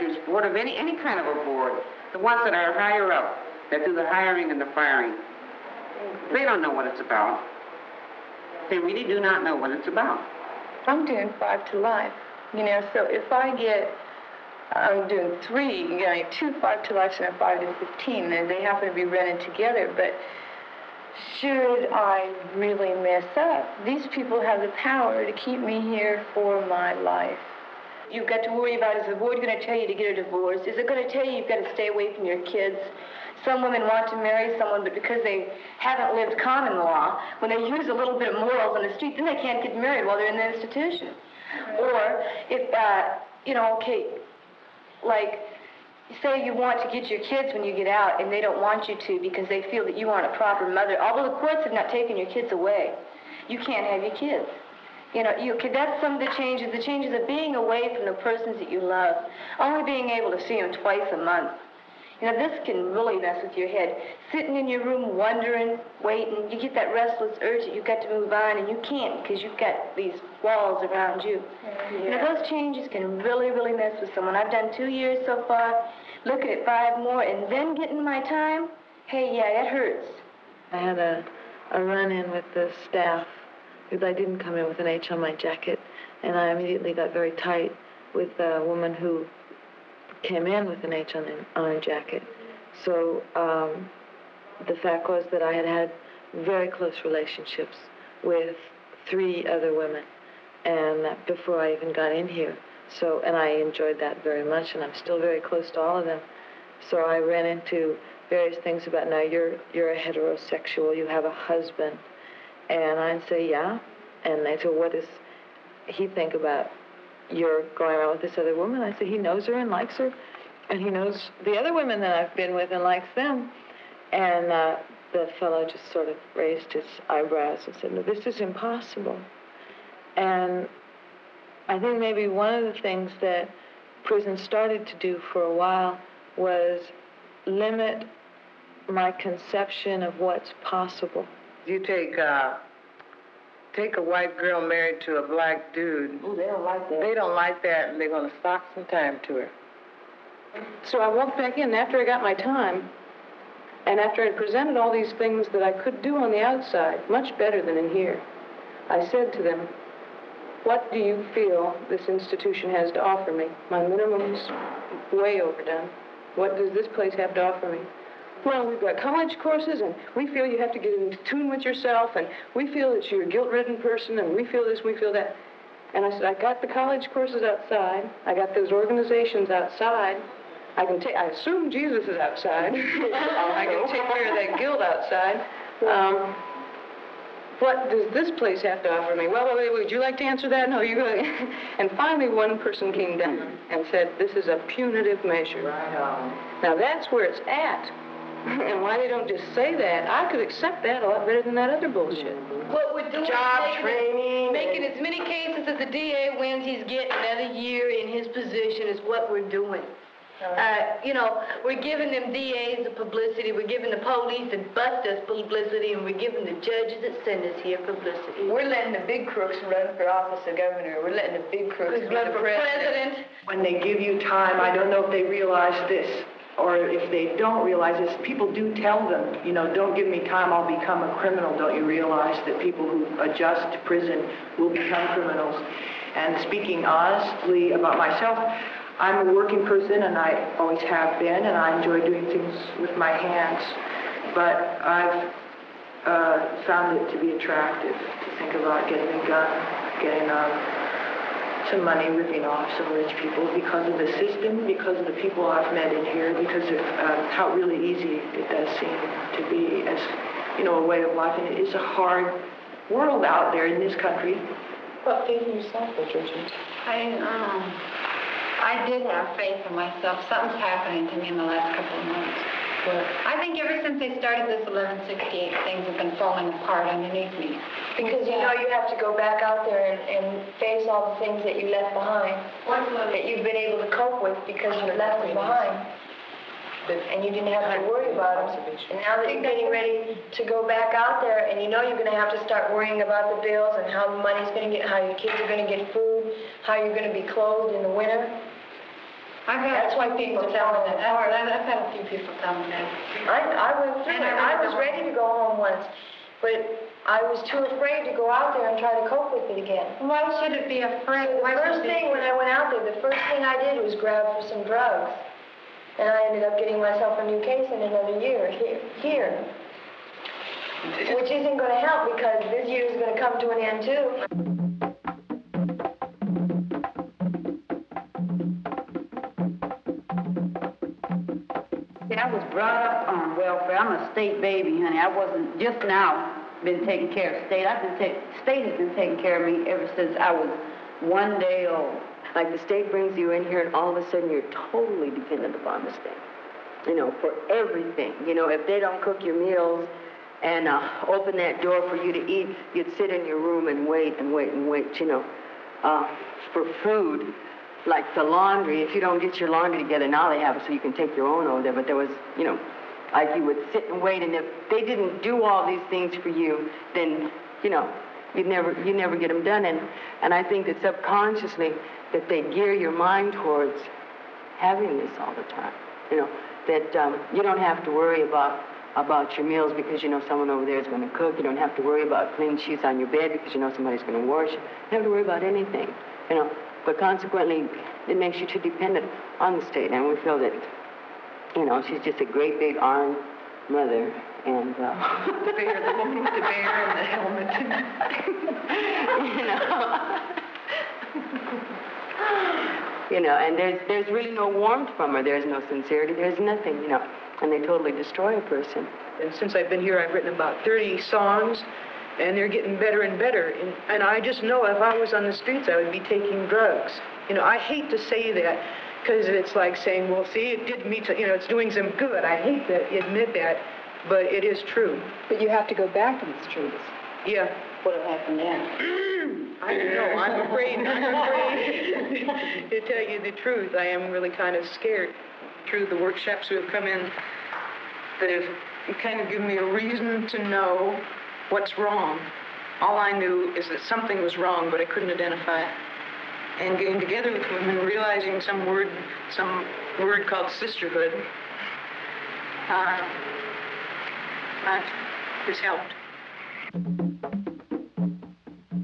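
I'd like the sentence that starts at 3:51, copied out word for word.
Don't you realize that people who adjust to prison will become criminals?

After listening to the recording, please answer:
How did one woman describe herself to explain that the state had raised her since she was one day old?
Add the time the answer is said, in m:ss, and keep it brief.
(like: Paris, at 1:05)
a state baby, at 5:34.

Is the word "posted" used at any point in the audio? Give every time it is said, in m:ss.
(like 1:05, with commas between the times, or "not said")
not said.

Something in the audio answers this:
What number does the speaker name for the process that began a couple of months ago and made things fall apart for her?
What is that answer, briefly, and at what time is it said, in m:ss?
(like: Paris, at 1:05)
1168, at 4:34.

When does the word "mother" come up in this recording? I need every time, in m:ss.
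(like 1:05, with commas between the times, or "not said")
0:50, 6:33.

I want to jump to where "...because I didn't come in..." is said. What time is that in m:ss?
1:23.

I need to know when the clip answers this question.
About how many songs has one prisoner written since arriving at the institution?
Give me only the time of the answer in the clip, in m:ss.
6:50.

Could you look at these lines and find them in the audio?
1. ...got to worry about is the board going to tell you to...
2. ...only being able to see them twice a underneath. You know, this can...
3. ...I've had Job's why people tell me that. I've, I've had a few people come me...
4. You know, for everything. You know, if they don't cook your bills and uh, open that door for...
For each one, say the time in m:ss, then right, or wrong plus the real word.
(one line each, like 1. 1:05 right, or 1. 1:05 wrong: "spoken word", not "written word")
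1. 0:28 right
2. 0:59 wrong: "month", not "underneath"
3. 4:59 wrong: "That", not "Job"
4. 5:46 wrong: "meals", not "bills".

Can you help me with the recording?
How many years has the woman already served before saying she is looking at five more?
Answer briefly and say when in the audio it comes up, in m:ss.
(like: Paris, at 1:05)
2, at 1:14.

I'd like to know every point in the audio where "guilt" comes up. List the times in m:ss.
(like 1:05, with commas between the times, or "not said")
2:53, 3:04.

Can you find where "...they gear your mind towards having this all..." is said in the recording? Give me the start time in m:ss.
6:12.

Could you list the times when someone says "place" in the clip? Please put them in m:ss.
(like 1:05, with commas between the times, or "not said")
2:46, 3:08.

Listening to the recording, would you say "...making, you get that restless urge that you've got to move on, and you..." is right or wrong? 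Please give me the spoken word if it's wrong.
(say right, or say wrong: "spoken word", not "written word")
wrong: "waiting", not "making".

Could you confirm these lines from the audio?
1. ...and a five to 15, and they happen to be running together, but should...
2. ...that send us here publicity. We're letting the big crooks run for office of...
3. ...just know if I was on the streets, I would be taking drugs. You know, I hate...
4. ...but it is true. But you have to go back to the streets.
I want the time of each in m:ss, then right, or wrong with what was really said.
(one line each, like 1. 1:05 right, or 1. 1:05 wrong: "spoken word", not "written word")
1. 0:17 right
2. 3:37 right
3. 6:54 right
4. 7:04 right.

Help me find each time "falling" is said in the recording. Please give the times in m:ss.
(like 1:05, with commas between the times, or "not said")
4:36.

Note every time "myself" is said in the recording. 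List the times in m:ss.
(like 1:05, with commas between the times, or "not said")
3:57, 4:29, 5:16.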